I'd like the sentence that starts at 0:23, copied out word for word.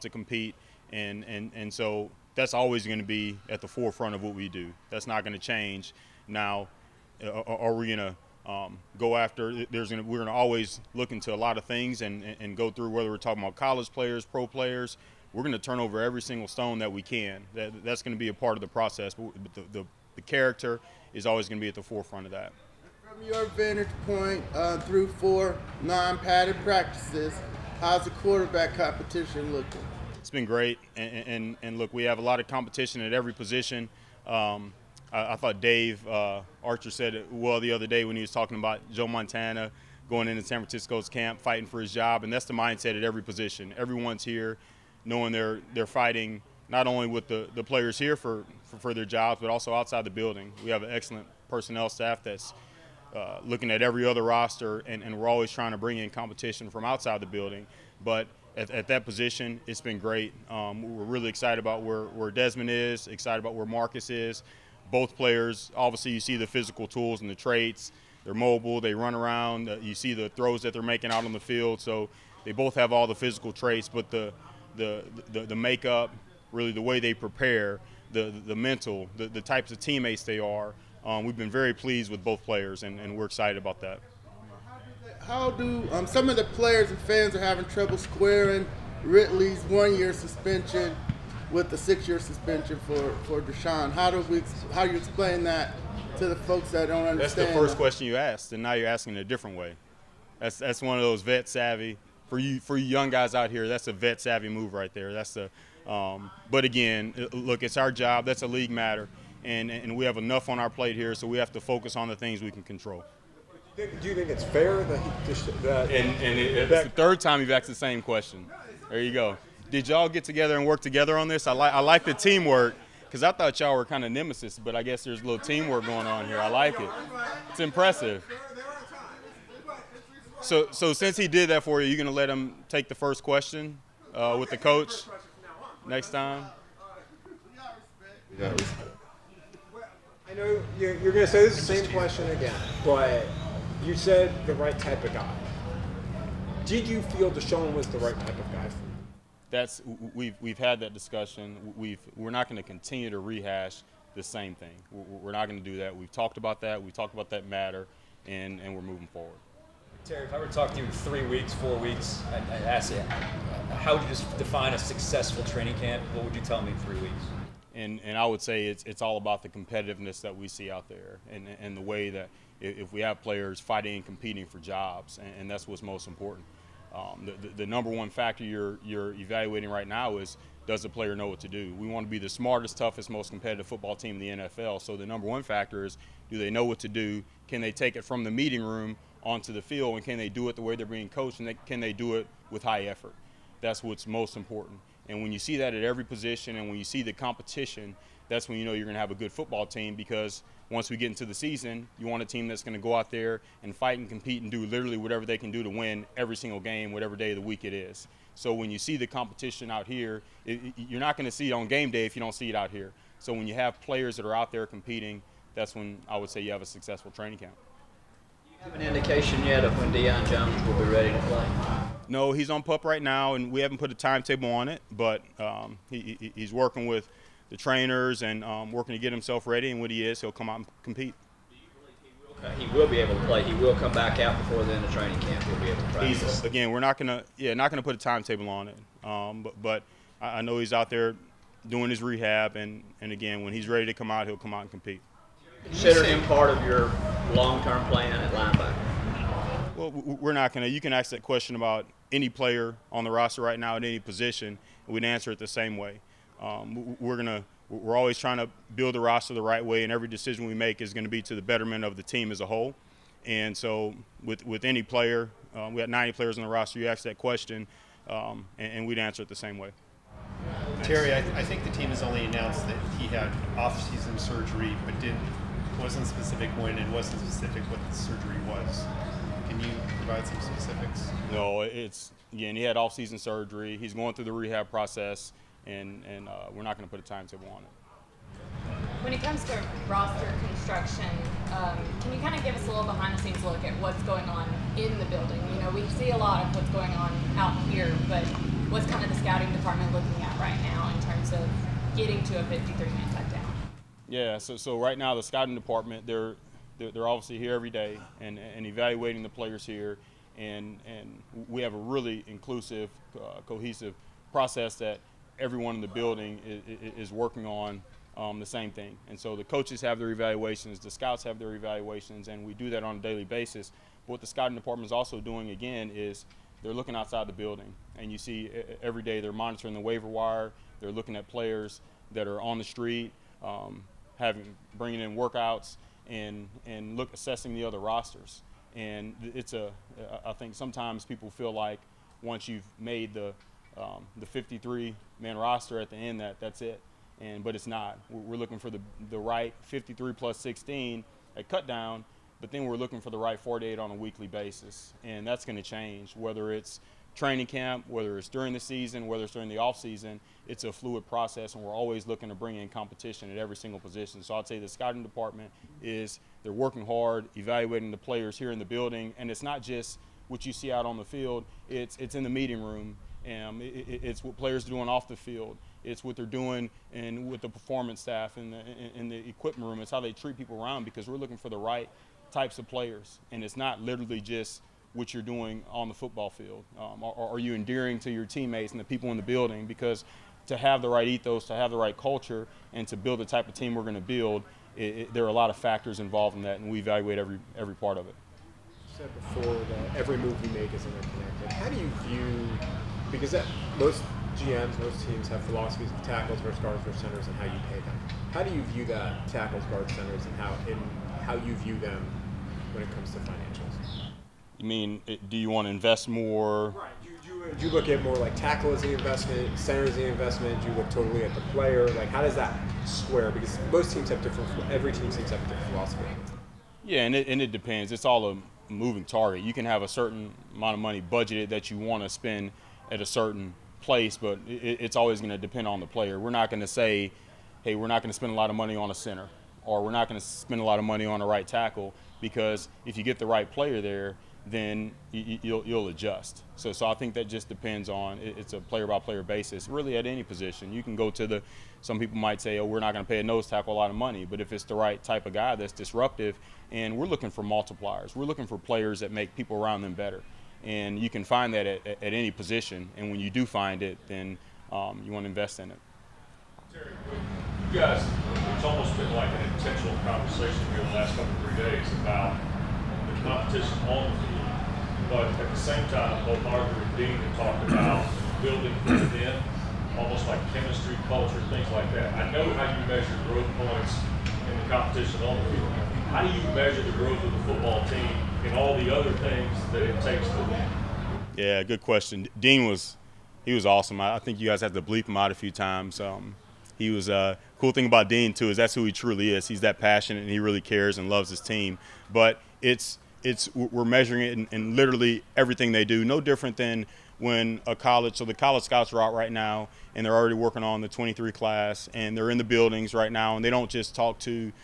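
From your vantage point, uh, through four non-padded practices, How's the quarterback competition looking?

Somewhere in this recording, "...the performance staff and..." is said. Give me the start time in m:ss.
6:17.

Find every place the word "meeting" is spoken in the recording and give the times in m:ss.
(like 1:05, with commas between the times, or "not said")
3:08, 6:12.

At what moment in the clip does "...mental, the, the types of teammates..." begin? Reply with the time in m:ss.
1:18.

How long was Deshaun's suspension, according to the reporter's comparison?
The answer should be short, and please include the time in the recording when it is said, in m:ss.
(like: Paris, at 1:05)
6 years, at 1:31.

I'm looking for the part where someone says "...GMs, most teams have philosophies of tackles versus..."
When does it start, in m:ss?
6:44.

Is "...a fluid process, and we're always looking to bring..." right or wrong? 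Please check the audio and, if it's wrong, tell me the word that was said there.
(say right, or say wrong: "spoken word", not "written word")
right.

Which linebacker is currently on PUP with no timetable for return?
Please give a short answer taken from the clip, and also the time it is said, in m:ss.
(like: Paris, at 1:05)
Deion Jones, at 3:39.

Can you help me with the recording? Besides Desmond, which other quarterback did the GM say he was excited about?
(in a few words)
Marcus.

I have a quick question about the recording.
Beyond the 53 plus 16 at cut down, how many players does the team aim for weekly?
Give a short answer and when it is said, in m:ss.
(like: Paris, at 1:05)
48, at 5:53.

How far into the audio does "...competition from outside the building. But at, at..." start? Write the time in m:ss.
0:56.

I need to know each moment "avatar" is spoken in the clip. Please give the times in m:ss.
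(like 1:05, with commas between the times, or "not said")
not said.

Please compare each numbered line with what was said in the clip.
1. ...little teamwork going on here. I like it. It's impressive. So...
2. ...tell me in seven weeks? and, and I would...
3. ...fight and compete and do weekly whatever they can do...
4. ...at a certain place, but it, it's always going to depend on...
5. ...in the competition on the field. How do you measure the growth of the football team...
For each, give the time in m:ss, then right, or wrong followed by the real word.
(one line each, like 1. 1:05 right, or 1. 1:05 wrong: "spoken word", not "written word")
1. 2:05 right
2. 2:46 wrong: "three", not "seven"
3. 3:23 wrong: "literally", not "weekly"
4. 7:12 right
5. 8:04 right.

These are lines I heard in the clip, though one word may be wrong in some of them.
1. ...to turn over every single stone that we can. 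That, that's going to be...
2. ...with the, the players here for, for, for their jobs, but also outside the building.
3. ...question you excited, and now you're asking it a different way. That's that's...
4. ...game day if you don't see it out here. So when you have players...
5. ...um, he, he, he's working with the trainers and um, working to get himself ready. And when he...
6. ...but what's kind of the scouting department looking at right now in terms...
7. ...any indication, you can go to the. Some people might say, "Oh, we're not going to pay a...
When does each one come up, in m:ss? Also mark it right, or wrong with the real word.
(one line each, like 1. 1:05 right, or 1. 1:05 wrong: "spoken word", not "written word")
1. 0:15 right
2. 0:47 right
3. 1:37 wrong: "asked", not "excited"
4. 3:31 right
5. 3:45 right
6. 4:58 right
7. 7:30 wrong: "position", not "indication".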